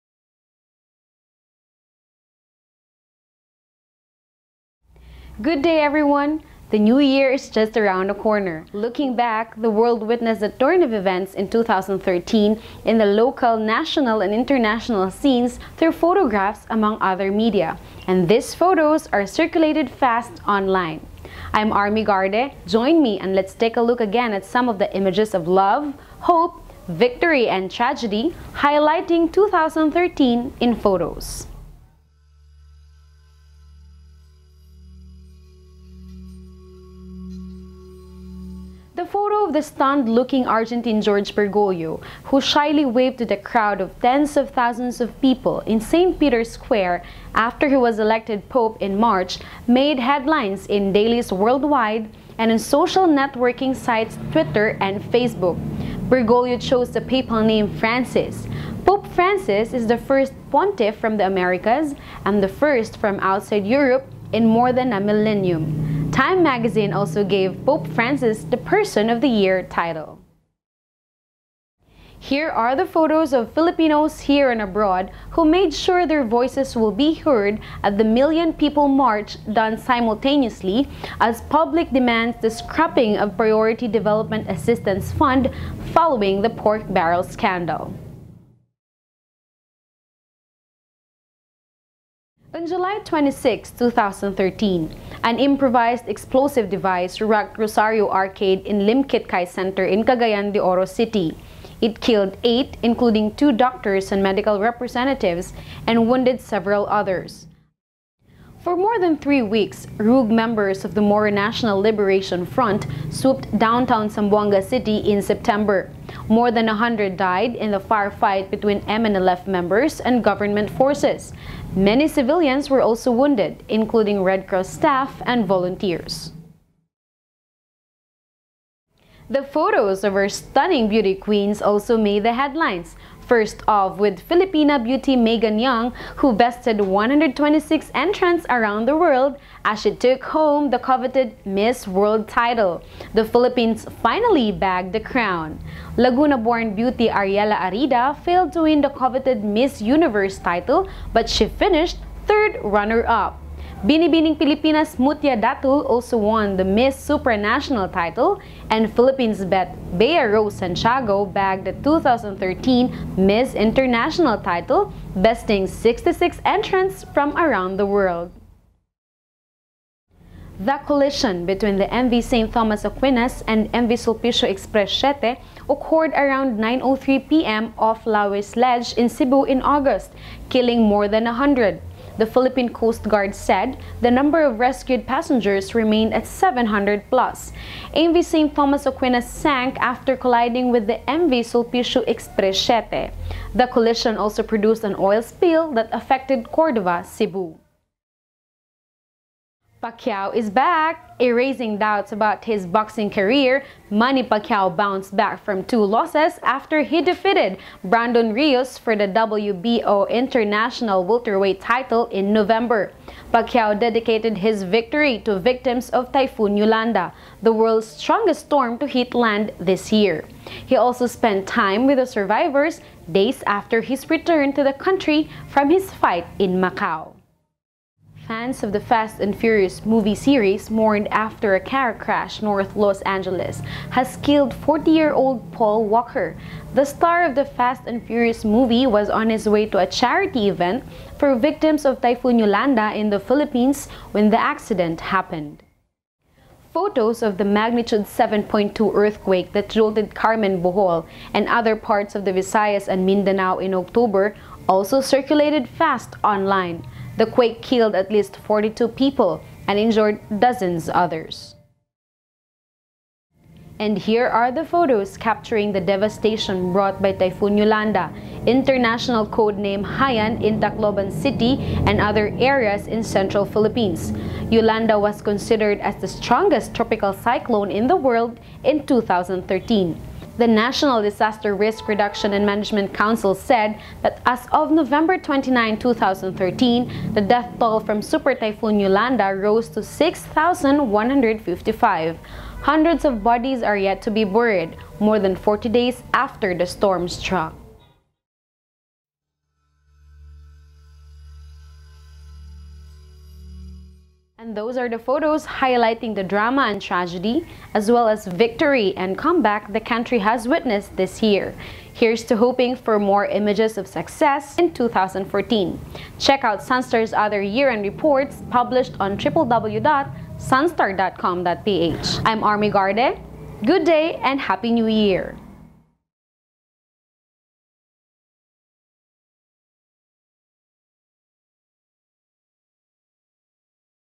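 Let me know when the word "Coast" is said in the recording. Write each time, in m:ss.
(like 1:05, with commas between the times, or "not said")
3:02.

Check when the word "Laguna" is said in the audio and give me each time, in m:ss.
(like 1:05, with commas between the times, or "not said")
2:25.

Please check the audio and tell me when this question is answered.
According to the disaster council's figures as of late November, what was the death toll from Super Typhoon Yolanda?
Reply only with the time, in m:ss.
4:49.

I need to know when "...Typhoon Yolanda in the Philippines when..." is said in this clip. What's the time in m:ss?
4:01.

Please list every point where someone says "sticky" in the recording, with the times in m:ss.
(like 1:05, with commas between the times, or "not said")
not said.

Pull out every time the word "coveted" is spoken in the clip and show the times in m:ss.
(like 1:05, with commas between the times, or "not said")
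2:20, 2:28.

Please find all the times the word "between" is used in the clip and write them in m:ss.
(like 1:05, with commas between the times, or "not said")
1:58, 2:51.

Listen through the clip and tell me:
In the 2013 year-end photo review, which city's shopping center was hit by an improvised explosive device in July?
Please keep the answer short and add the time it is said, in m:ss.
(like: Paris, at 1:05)
Cagayan de Oro City, at 1:40.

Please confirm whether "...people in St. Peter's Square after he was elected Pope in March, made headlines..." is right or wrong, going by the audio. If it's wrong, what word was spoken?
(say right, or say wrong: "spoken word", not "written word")
right.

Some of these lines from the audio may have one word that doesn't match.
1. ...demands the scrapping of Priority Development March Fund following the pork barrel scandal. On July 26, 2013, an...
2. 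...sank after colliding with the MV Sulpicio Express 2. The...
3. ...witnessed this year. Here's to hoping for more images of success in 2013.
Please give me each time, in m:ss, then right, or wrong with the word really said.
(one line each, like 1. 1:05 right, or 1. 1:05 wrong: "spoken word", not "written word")
1. 1:21 wrong: "Assistance", not "March"
2. 3:09 wrong: "7", not "2"
3. 5:10 wrong: "2014", not "2013".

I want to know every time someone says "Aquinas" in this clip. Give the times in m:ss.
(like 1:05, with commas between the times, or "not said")
2:52, 3:08.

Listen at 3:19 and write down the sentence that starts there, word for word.
Pacquiao is back, erasing doubts about his boxing career.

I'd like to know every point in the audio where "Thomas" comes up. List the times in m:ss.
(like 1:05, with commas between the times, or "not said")
2:52, 3:08.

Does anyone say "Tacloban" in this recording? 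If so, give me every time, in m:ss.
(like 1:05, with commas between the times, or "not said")
4:30.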